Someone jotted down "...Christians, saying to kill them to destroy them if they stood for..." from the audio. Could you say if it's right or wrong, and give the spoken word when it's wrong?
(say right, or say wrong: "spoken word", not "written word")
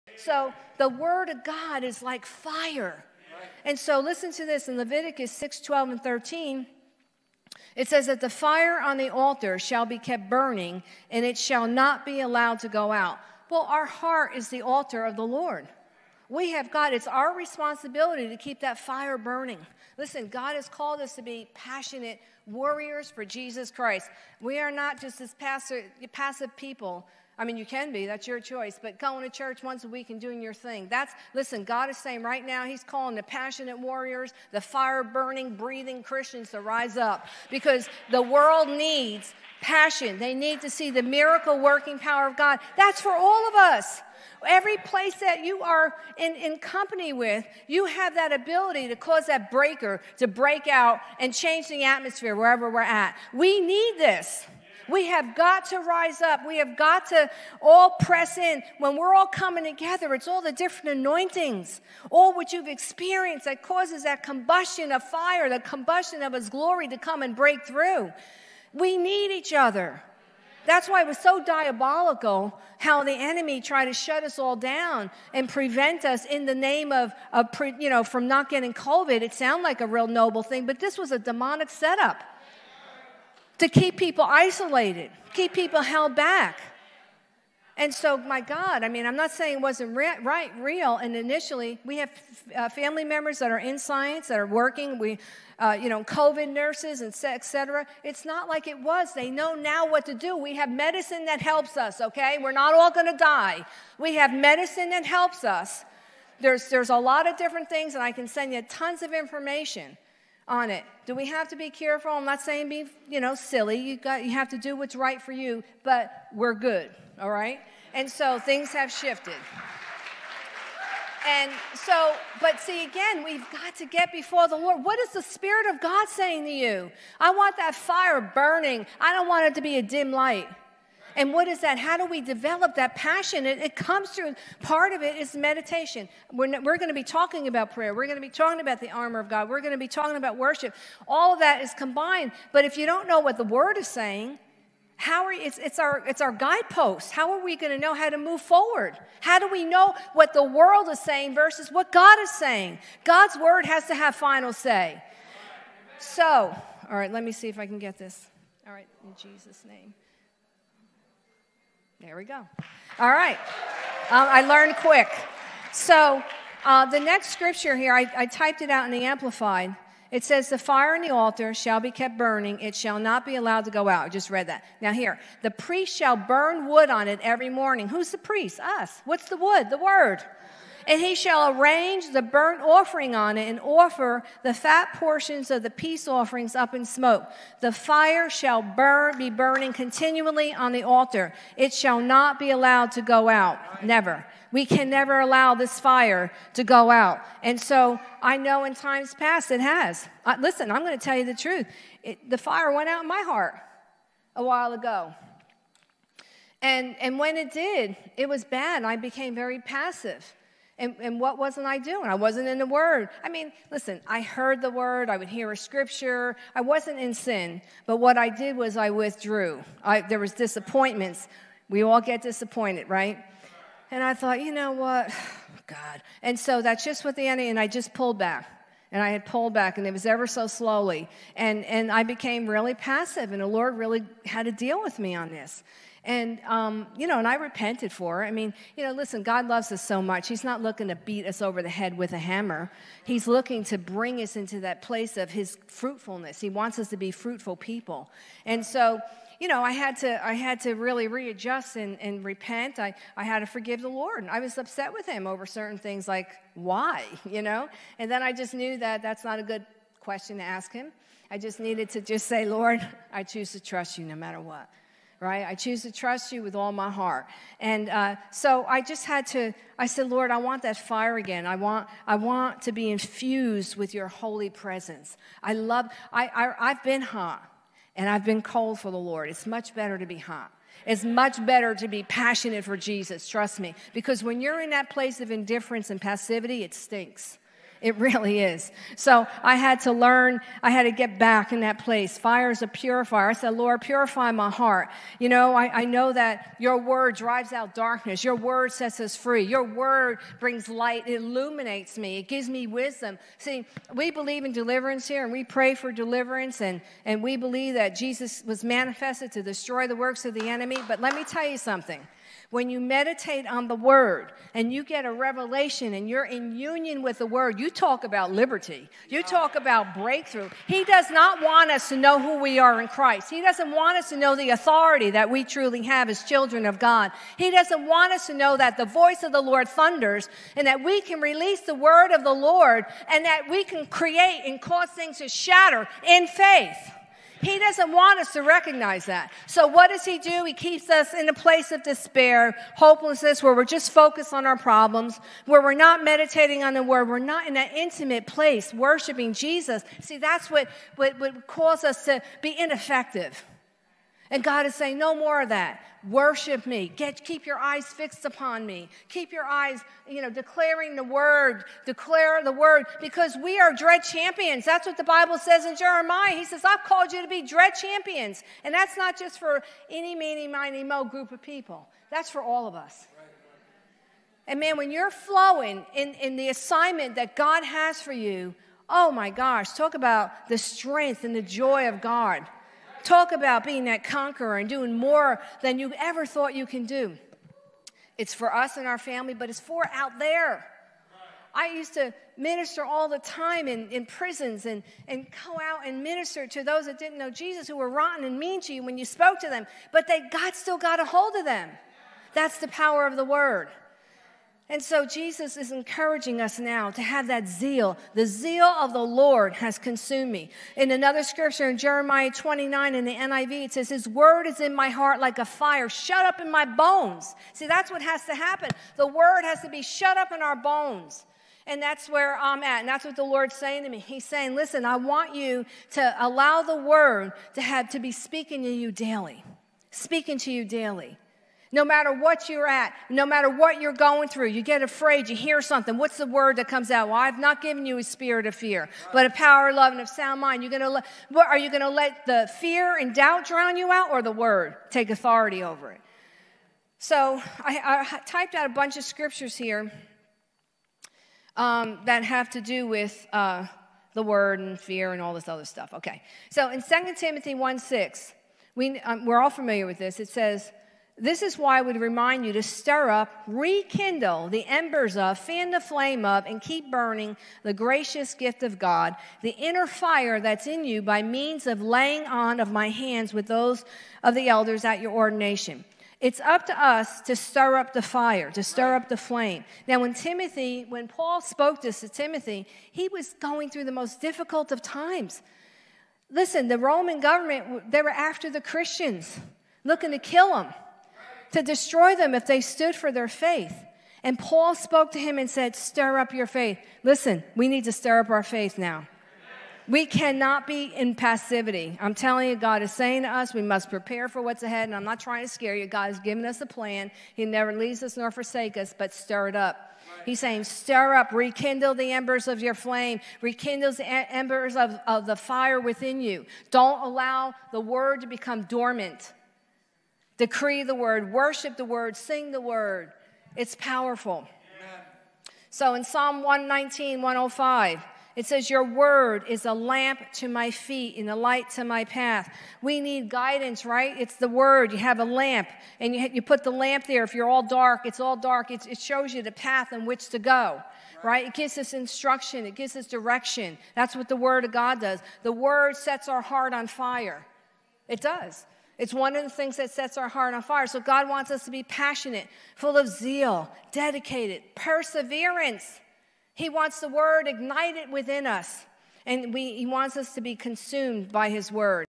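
wrong: "looking", not "saying".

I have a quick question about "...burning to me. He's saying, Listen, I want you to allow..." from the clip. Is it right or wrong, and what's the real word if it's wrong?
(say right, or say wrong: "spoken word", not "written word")
wrong: "saying", not "burning".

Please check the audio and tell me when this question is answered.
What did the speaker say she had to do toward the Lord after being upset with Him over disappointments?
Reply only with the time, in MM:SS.
04:13.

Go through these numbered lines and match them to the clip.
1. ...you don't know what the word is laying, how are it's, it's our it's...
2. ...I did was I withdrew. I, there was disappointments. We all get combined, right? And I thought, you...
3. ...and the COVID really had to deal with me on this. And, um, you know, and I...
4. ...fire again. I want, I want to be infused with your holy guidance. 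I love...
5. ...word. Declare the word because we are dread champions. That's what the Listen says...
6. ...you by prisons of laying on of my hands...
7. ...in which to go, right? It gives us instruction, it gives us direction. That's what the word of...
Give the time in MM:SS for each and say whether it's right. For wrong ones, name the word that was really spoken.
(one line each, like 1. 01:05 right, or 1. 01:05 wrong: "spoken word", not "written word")
1. 02:22 wrong: "saying", not "laying"
2. 03:38 wrong: "disappointed", not "combined"
3. 03:53 wrong: "Lord", not "COVID"
4. 04:30 wrong: "presence", not "guidance"
5. 06:01 wrong: "Bible", not "Listen"
6. 07:50 wrong: "means", not "prisons"
7. 08:59 right.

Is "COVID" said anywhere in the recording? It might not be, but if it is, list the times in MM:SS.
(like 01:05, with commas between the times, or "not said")
01:18, 01:36.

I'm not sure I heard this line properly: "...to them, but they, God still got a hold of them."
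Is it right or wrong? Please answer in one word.
right.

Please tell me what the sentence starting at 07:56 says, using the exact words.
It's up to us to stir up the fire, to stir up the flame.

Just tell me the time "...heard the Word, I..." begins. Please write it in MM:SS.
03:34.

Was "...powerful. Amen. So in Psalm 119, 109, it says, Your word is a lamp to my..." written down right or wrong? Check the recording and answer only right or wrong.
wrong.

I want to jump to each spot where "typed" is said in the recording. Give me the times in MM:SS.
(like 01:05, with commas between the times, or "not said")
02:48, 07:28.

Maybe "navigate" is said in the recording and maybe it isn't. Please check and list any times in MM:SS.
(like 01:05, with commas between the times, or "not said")
not said.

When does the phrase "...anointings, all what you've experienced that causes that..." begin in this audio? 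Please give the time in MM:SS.
01:00.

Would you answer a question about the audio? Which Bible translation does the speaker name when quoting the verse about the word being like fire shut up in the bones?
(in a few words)
NIV.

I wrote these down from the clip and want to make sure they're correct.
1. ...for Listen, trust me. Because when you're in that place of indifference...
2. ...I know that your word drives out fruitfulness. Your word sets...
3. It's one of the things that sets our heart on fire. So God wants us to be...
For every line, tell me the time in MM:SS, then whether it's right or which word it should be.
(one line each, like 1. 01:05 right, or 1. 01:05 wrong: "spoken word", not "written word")
1. 04:42 wrong: "Jesus", not "Listen"
2. 04:55 wrong: "darkness", not "fruitfulness"
3. 09:09 right.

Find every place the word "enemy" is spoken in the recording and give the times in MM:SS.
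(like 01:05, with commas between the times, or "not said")
01:13, 03:47, 05:10.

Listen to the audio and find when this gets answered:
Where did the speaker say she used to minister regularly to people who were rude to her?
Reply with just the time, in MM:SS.
06:34.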